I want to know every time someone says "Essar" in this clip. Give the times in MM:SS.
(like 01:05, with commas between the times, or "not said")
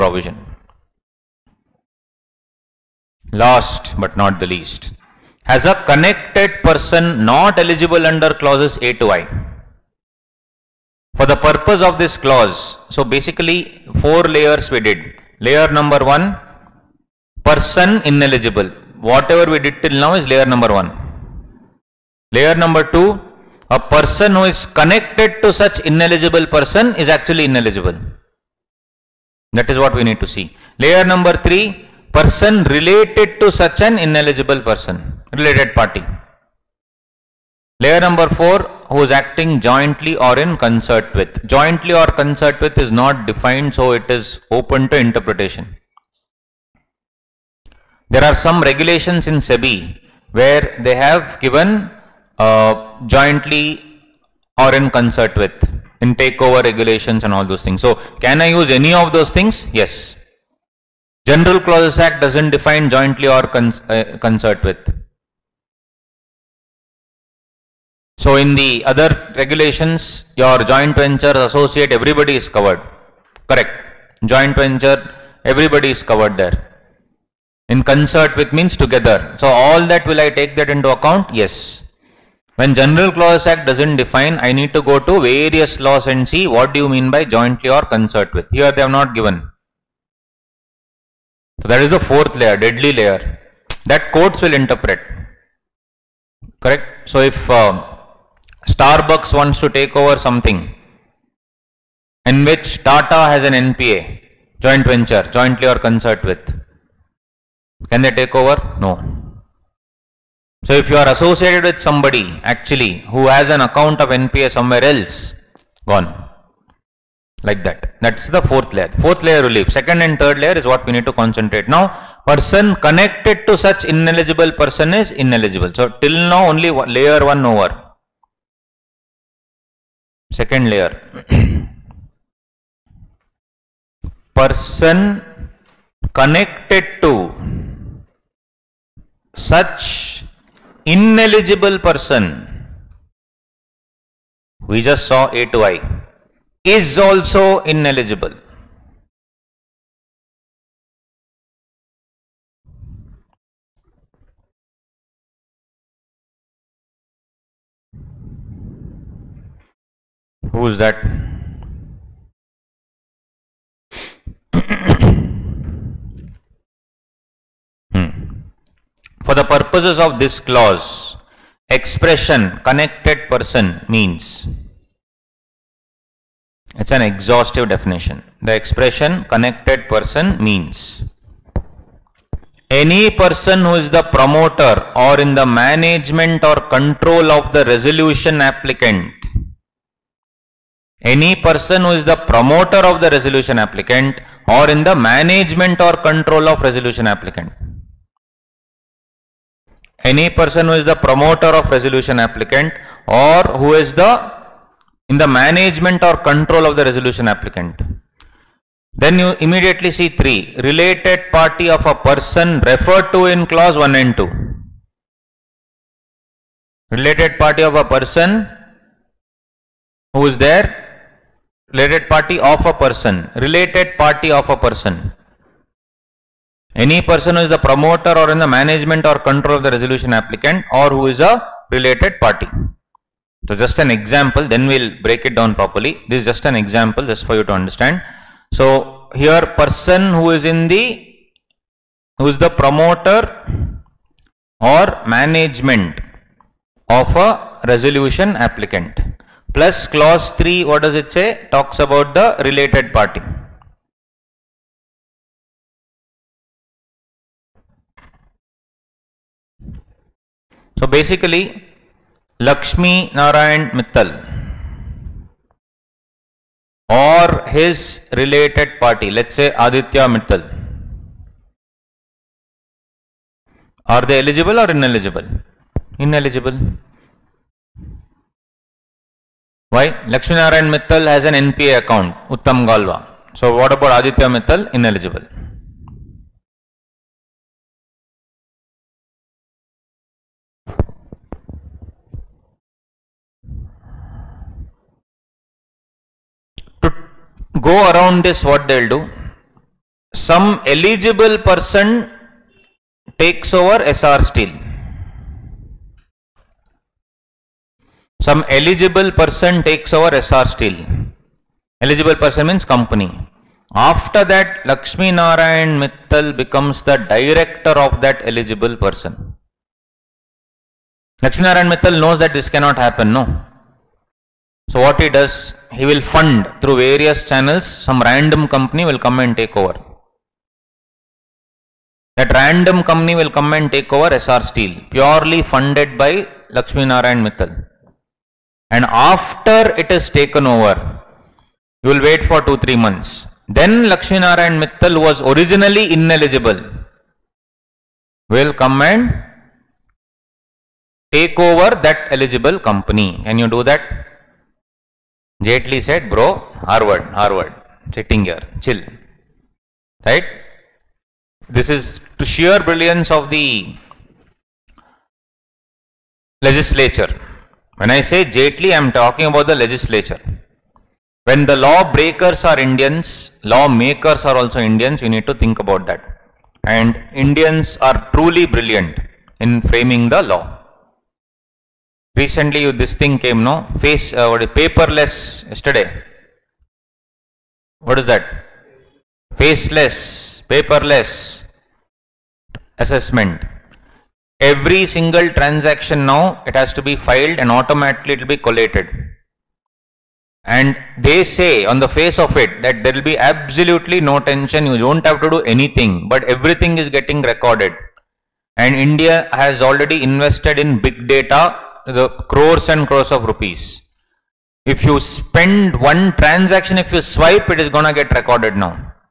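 05:03, 05:10, 05:34.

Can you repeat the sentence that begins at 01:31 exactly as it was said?
So that is the fourth layer, deadly layer that courts will interpret.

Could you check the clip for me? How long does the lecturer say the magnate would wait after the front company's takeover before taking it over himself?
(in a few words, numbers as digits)
2-3 months.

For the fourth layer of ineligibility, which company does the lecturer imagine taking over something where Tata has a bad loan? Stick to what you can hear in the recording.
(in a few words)
Starbucks.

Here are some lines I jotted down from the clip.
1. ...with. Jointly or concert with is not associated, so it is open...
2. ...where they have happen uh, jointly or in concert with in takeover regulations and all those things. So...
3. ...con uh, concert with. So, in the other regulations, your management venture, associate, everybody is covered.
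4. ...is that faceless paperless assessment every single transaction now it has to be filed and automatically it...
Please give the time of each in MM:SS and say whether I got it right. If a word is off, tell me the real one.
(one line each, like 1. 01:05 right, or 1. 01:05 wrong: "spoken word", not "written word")
1. 00:41 wrong: "defined", not "associated"
2. 00:50 wrong: "given", not "happen"
3. 01:03 wrong: "joint", not "management"
4. 06:28 right.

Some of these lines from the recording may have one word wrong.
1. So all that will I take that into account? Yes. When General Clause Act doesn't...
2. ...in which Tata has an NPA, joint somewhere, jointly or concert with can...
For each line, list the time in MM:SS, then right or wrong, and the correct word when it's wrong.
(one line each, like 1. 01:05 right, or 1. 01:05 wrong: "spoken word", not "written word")
1. 01:19 right
2. 01:42 wrong: "venture", not "somewhere".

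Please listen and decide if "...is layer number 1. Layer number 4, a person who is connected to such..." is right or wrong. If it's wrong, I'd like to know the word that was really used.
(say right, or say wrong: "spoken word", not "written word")
wrong: "2", not "4".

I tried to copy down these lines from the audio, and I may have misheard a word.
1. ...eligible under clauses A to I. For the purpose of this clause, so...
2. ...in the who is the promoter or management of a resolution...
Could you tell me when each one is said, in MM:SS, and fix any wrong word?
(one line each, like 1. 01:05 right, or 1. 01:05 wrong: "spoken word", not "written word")
1. 00:07 right
2. 04:00 right.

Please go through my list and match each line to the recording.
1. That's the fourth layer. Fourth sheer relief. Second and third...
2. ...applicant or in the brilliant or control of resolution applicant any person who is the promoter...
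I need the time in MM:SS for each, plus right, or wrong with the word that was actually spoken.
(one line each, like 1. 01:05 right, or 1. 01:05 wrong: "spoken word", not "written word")
1. 01:58 wrong: "layer", not "sheer"
2. 03:13 wrong: "management", not "brilliant".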